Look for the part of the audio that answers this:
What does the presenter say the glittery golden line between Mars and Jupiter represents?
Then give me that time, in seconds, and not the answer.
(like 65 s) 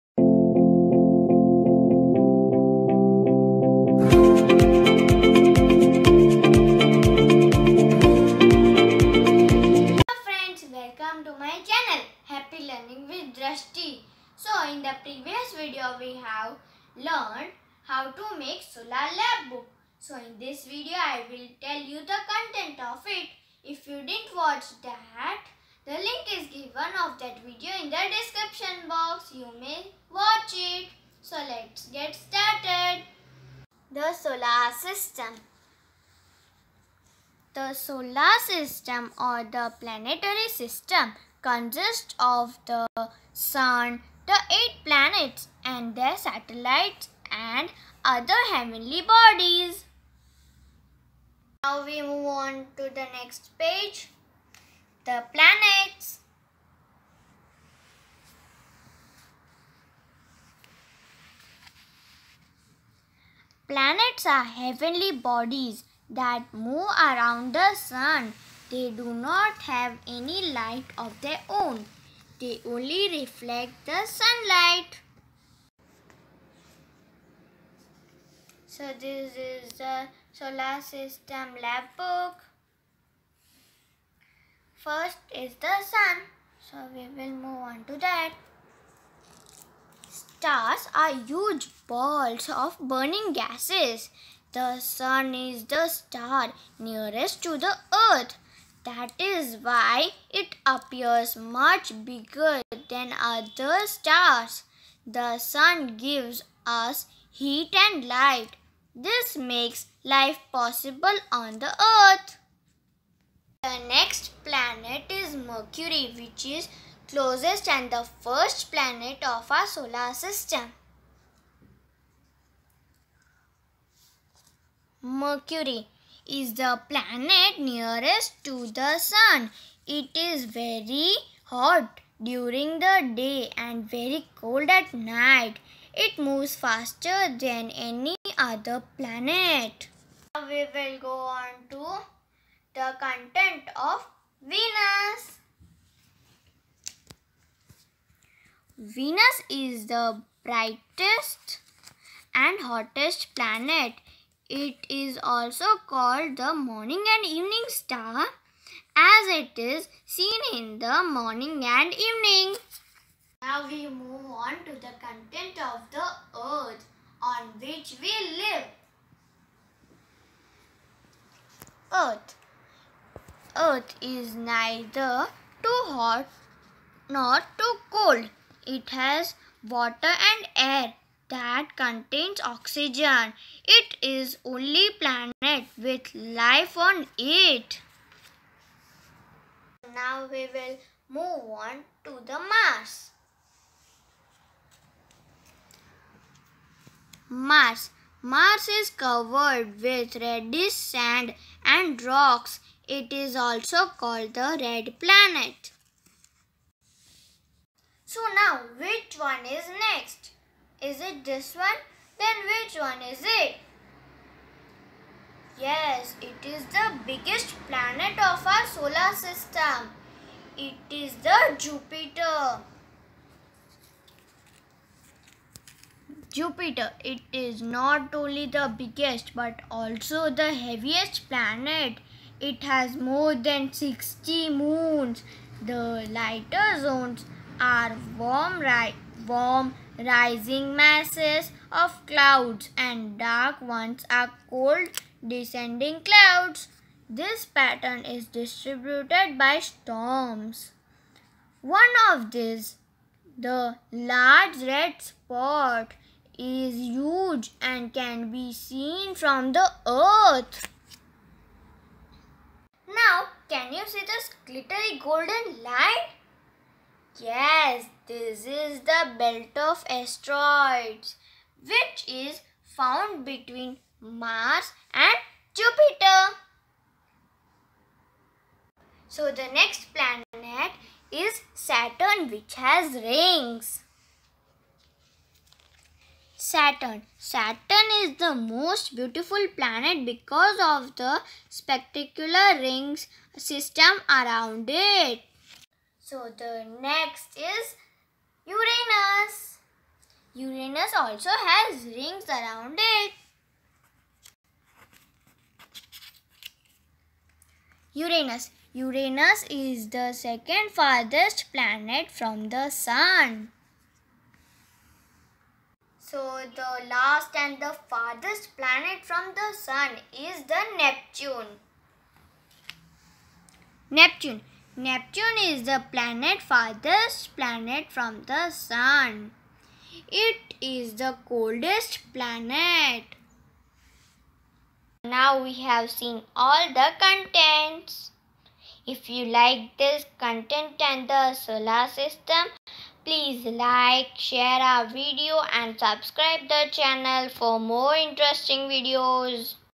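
269 s.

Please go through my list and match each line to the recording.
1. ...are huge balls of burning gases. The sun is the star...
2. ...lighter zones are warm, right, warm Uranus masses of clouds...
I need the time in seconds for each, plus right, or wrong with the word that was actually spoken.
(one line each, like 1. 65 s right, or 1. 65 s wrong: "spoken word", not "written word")
1. 90 s right
2. 236 s wrong: "Rising", not "Uranus".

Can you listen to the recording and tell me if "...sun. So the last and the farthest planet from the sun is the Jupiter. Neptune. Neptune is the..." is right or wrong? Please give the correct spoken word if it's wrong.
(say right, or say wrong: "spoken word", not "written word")
wrong: "Neptune", not "Jupiter".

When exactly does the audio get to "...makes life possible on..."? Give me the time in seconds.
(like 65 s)
109 s.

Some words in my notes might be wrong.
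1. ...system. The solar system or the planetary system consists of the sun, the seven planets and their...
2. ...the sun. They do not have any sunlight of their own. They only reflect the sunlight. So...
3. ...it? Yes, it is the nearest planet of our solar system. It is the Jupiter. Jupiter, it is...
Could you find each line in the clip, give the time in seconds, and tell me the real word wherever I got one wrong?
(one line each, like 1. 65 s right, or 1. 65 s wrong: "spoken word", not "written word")
1. 34 s wrong: "eight", not "seven"
2. 67 s wrong: "light", not "sunlight"
3. 213 s wrong: "biggest", not "nearest".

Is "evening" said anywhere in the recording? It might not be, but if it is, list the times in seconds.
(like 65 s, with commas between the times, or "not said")
157 s, 161 s.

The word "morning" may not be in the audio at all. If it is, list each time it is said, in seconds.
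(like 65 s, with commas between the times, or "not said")
156 s, 161 s.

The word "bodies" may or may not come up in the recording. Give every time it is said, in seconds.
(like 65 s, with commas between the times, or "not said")
49 s, 65 s.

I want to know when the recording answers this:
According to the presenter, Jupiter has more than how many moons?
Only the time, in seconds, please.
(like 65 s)
232 s.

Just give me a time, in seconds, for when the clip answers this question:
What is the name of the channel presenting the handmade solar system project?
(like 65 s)
12 s.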